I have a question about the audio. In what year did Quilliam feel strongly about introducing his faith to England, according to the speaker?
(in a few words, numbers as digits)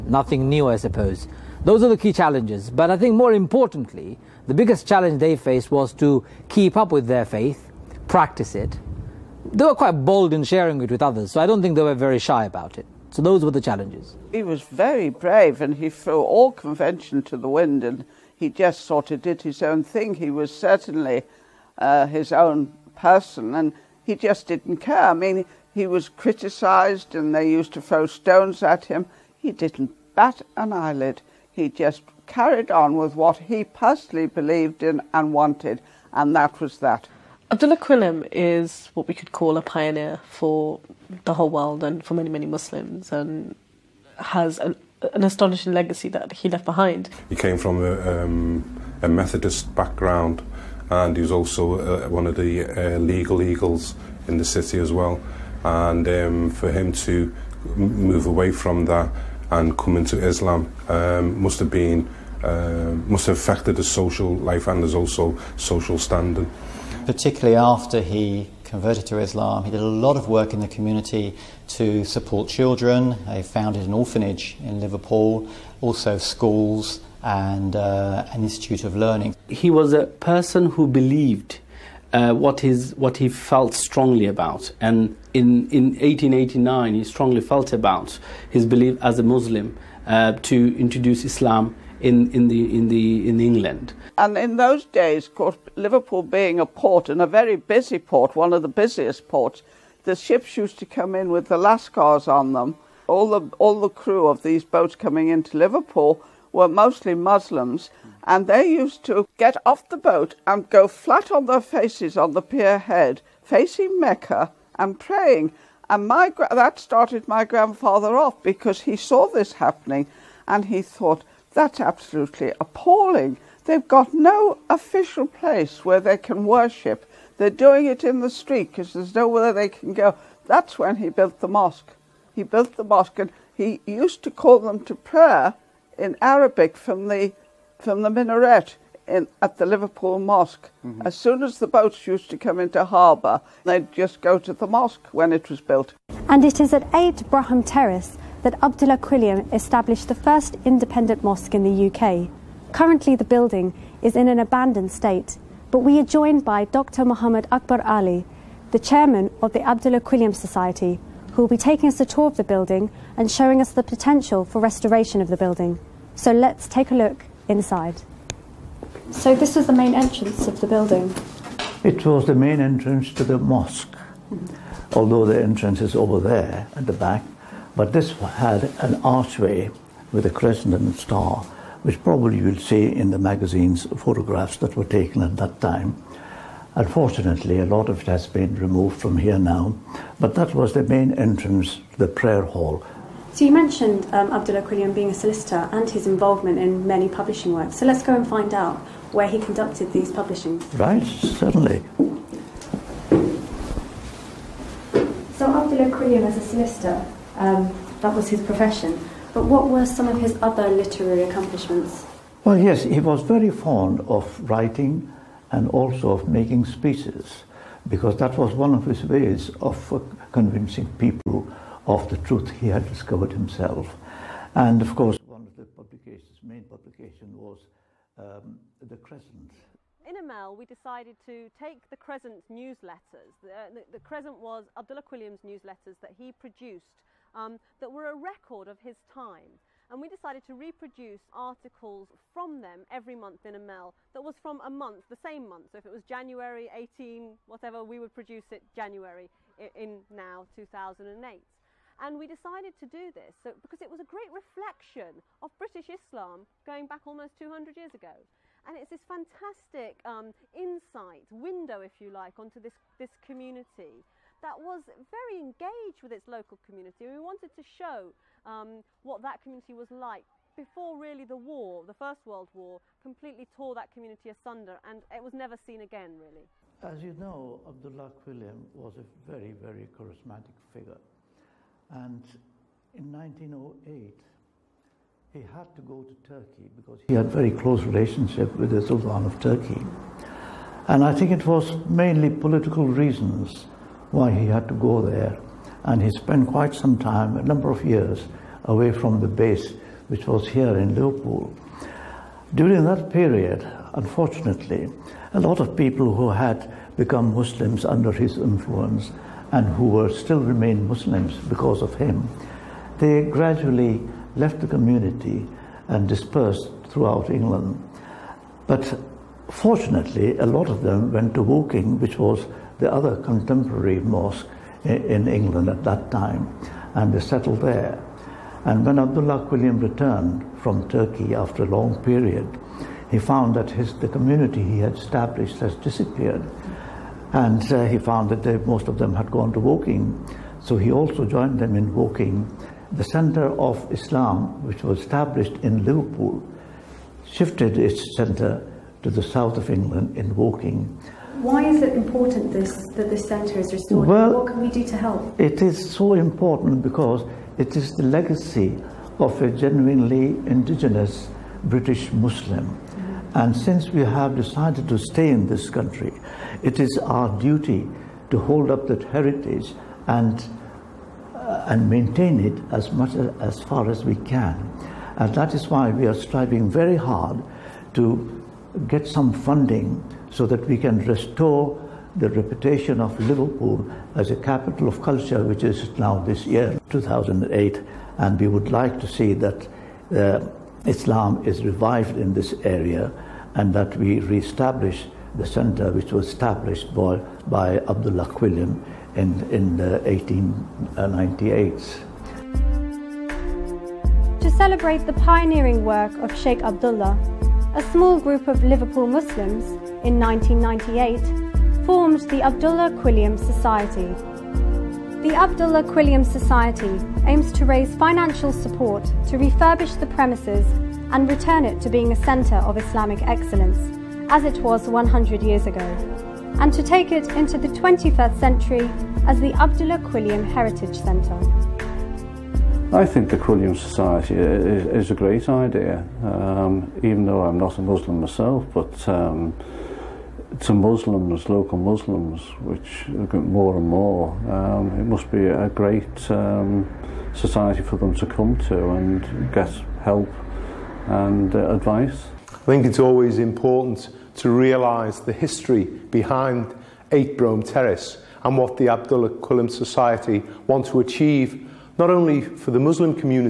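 1889.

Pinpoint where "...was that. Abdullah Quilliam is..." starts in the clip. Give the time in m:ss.
0:36.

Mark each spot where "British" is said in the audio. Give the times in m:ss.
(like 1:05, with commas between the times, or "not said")
4:15, 6:01.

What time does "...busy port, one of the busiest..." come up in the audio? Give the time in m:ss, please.
1:37.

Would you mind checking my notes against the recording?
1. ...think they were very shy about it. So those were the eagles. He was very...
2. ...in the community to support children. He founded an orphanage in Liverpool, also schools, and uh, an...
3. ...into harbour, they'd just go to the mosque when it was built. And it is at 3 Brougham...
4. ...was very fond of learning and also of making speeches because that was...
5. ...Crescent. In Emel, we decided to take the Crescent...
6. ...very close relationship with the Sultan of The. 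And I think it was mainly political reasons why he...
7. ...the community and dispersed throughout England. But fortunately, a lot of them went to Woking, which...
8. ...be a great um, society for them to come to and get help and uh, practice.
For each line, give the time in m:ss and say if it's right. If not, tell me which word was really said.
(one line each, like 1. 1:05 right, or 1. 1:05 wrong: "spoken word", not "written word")
1. 0:11 wrong: "challenges", not "eagles"
2. 1:10 right
3. 2:22 wrong: "8", not "3"
4. 3:32 wrong: "writing", not "learning"
5. 3:48 right
6. 4:47 wrong: "Turkey", not "The"
7. 5:14 right
8. 7:25 wrong: "advice", not "practice".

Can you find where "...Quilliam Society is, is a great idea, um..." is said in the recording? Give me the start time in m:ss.
7:13.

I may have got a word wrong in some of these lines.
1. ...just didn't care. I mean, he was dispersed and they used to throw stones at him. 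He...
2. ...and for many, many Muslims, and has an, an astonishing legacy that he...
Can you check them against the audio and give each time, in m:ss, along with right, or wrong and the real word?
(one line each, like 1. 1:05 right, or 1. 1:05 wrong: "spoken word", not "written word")
1. 0:24 wrong: "criticised", not "dispersed"
2. 0:41 right.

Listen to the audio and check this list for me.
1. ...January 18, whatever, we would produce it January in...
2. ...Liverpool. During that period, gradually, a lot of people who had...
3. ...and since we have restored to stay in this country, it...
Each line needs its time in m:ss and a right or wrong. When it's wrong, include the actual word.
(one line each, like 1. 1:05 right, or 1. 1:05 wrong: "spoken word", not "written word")
1. 4:06 right
2. 5:00 wrong: "unfortunately", not "gradually"
3. 6:03 wrong: "decided", not "restored".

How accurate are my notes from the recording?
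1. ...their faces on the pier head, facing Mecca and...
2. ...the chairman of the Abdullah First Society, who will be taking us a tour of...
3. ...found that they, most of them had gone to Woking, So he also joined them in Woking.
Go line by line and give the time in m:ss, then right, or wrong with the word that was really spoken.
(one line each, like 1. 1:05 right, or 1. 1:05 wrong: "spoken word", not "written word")
1. 1:51 right
2. 2:38 wrong: "Quilliam", not "First"
3. 5:37 right.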